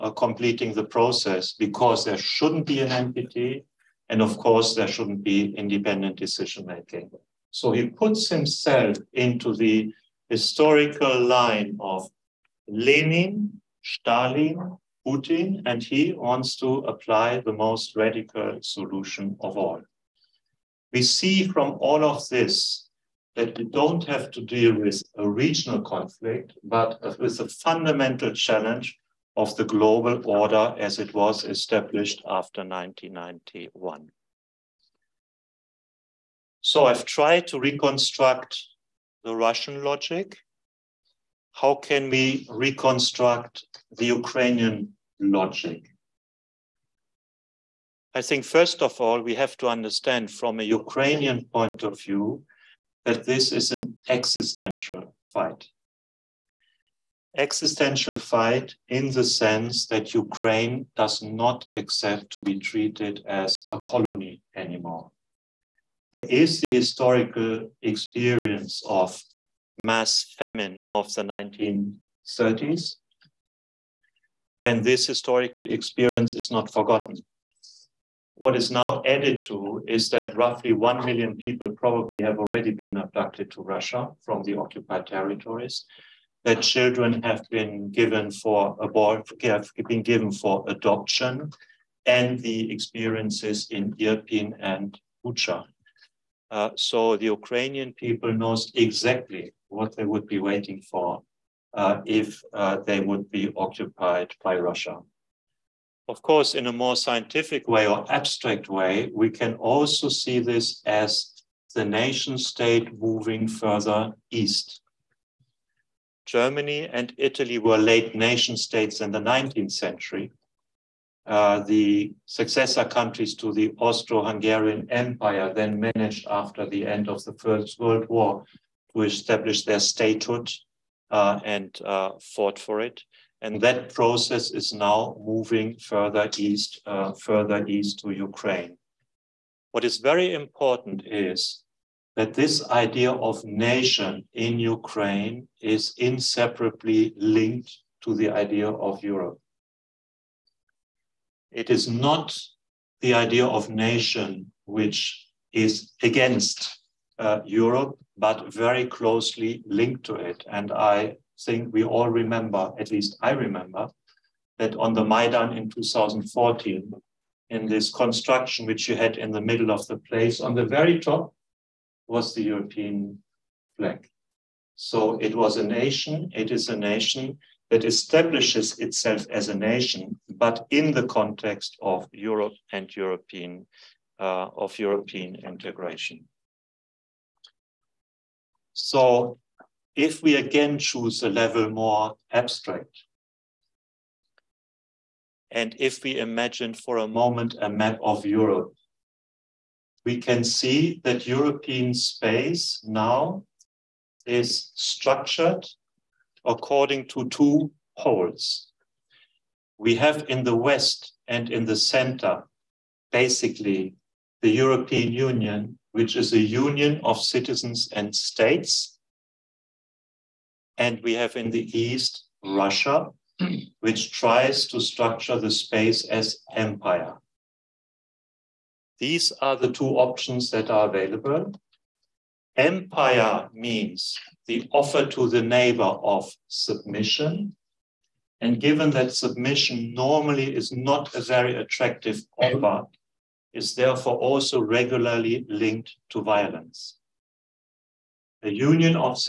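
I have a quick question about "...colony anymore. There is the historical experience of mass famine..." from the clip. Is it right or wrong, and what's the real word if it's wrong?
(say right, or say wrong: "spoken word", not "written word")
right.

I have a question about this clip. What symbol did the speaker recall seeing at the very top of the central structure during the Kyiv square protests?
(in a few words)
The European flag.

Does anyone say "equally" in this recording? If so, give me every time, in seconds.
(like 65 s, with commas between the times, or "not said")
not said.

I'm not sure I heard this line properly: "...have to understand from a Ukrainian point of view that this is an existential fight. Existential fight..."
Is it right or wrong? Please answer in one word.
right.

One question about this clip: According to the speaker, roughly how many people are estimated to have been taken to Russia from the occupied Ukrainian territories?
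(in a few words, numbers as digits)
1 million.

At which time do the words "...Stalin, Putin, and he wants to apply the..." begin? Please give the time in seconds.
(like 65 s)
13 s.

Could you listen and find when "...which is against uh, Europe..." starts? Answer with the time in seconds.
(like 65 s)
154 s.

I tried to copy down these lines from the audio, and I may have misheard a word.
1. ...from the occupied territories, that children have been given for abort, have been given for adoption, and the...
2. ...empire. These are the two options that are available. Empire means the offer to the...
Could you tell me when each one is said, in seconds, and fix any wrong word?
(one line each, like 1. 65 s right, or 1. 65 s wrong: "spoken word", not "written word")
1. 84 s right
2. 226 s right.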